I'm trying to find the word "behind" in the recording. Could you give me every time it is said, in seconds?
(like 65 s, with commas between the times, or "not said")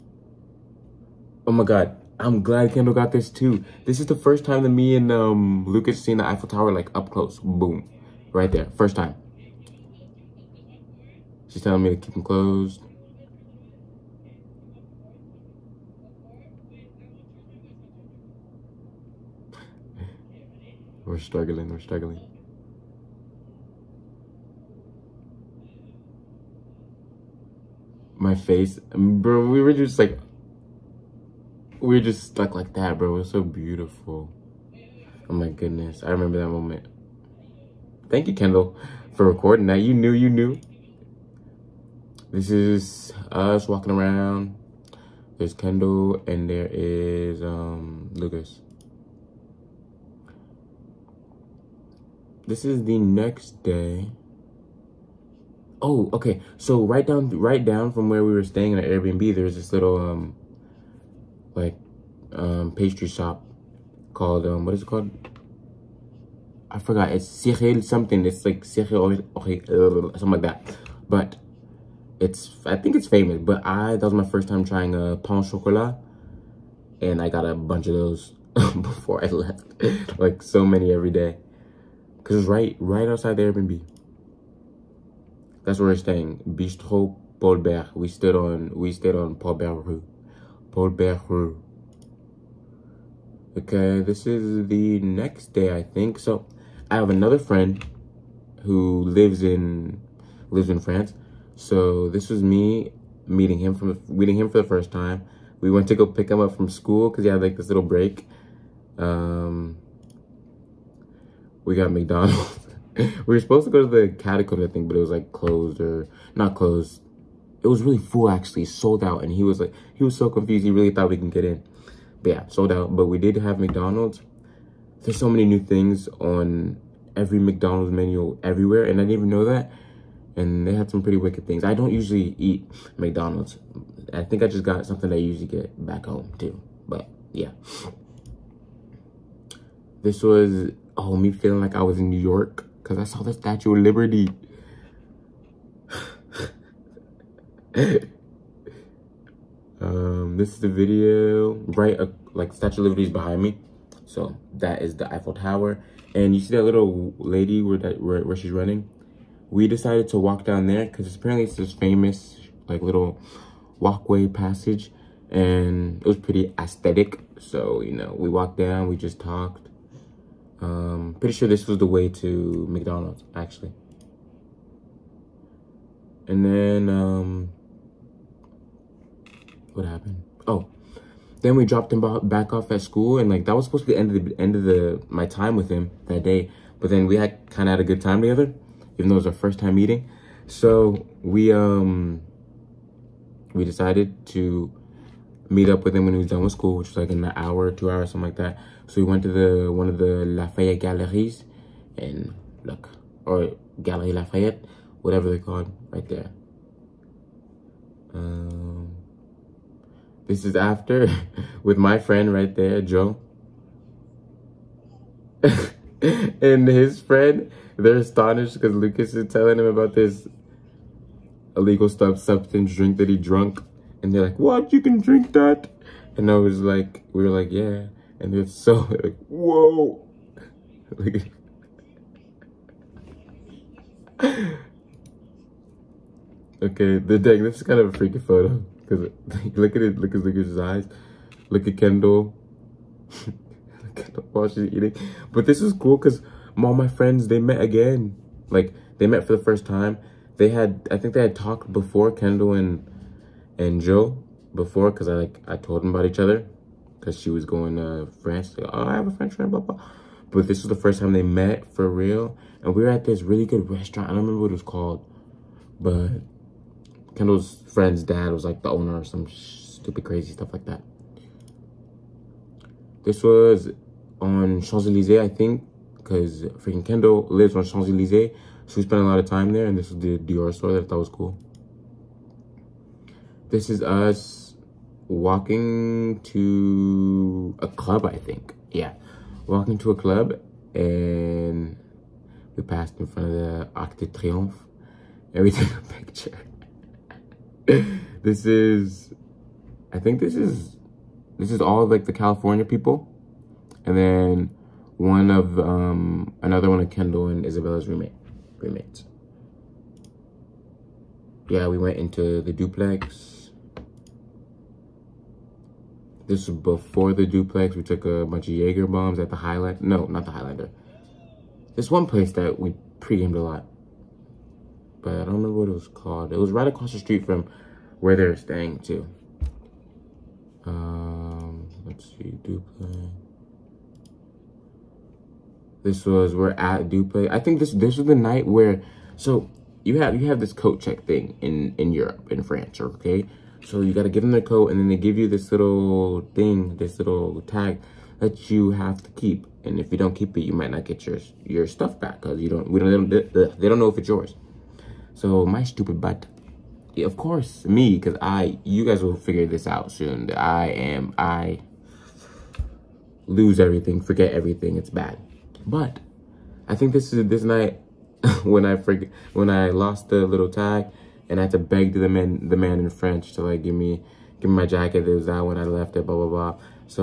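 153 s.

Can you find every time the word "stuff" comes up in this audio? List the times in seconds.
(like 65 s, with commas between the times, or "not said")
221 s, 270 s, 351 s.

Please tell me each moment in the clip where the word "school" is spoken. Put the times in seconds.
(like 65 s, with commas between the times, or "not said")
106 s, 182 s, 196 s.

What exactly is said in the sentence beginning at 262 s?
And we were at this really good restaurant.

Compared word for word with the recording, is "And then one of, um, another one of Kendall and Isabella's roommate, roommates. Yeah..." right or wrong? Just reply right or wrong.
right.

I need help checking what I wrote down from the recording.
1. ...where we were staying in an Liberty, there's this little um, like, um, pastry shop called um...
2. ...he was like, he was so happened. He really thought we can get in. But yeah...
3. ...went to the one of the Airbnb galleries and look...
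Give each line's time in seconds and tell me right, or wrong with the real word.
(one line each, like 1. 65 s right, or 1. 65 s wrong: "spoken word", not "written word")
1. 58 s wrong: "Airbnb", not "Liberty"
2. 119 s wrong: "confused", not "happened"
3. 199 s wrong: "Lafayette", not "Airbnb".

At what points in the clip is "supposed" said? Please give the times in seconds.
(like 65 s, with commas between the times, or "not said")
113 s, 183 s.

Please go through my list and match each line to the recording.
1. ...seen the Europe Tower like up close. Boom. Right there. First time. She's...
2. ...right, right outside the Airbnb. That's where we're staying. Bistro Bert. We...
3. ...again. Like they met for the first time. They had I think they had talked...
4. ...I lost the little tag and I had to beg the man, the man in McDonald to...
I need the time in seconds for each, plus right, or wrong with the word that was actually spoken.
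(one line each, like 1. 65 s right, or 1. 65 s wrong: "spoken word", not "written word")
1. 6 s wrong: "Eiffel", not "Europe"
2. 82 s right
3. 247 s right
4. 369 s wrong: "French", not "McDonald".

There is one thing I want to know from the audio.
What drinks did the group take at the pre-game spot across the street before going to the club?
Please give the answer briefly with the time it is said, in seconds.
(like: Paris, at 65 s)
Jaeger bombs, at 318 s.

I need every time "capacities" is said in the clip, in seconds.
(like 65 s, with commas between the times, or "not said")
not said.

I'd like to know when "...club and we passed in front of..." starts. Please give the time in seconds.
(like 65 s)
289 s.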